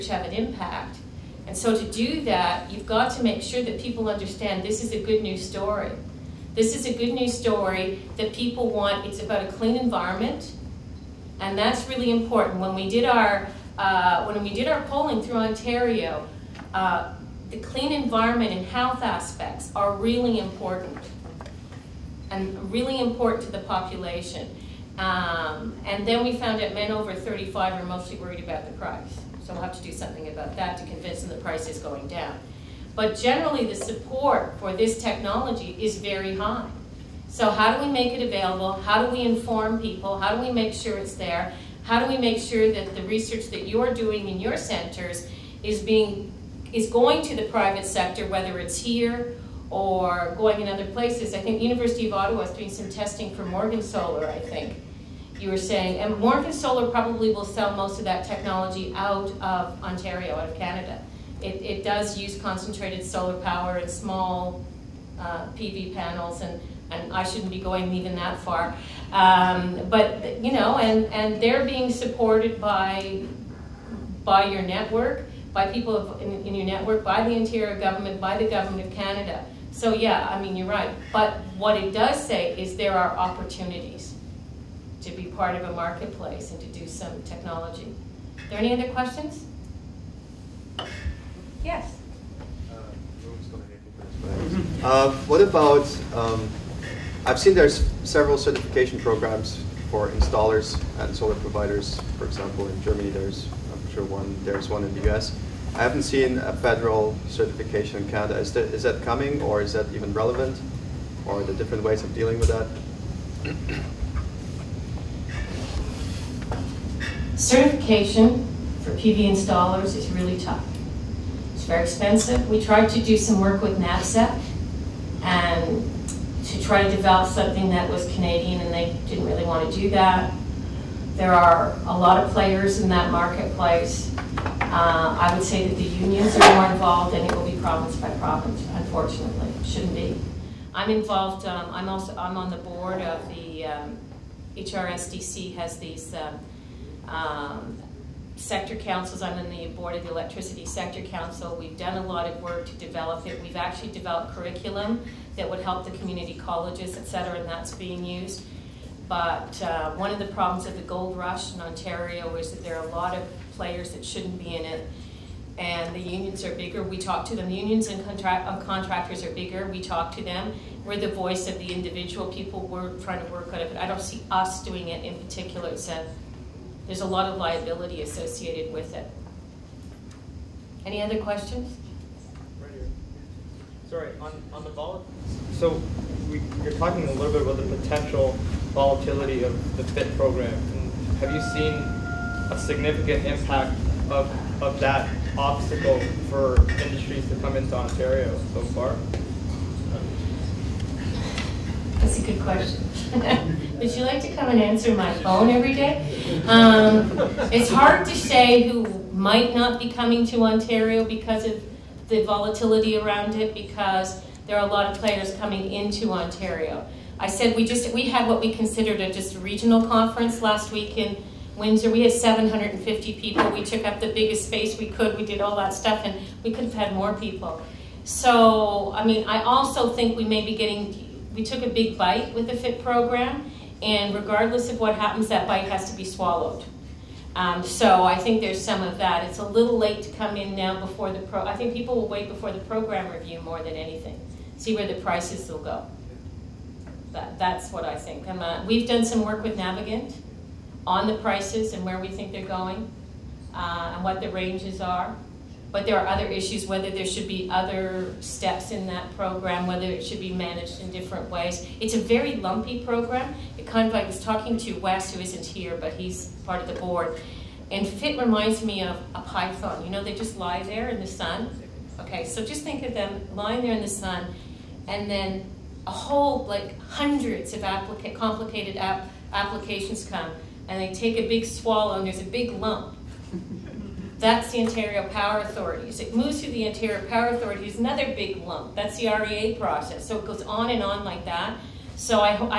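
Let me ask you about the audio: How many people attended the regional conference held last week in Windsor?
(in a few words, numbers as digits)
750.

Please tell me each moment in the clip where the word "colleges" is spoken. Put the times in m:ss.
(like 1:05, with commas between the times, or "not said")
2:36.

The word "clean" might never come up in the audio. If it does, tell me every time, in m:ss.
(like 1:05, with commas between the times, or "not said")
0:09, 0:17.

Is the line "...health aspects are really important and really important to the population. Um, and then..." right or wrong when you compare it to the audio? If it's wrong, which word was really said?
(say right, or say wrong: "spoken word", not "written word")
right.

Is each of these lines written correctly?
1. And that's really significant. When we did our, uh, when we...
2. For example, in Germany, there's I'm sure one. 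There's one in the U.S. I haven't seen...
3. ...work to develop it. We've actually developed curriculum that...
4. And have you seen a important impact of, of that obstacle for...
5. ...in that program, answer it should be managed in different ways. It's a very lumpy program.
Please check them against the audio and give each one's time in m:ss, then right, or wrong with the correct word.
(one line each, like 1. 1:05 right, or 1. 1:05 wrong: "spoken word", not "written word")
1. 0:11 wrong: "important", not "significant"
2. 1:42 right
3. 2:32 right
4. 3:10 wrong: "significant", not "important"
5. 4:18 wrong: "whether", not "answer".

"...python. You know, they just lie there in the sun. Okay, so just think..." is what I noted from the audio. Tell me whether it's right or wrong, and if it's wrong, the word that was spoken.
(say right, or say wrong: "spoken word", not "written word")
right.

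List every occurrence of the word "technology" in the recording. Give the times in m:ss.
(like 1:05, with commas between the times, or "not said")
0:35, 0:58, 1:27.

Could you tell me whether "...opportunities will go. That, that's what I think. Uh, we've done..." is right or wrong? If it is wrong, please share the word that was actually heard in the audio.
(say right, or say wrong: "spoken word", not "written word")
wrong: "prices", not "opportunities".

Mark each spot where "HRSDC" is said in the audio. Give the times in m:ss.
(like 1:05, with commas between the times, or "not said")
2:24.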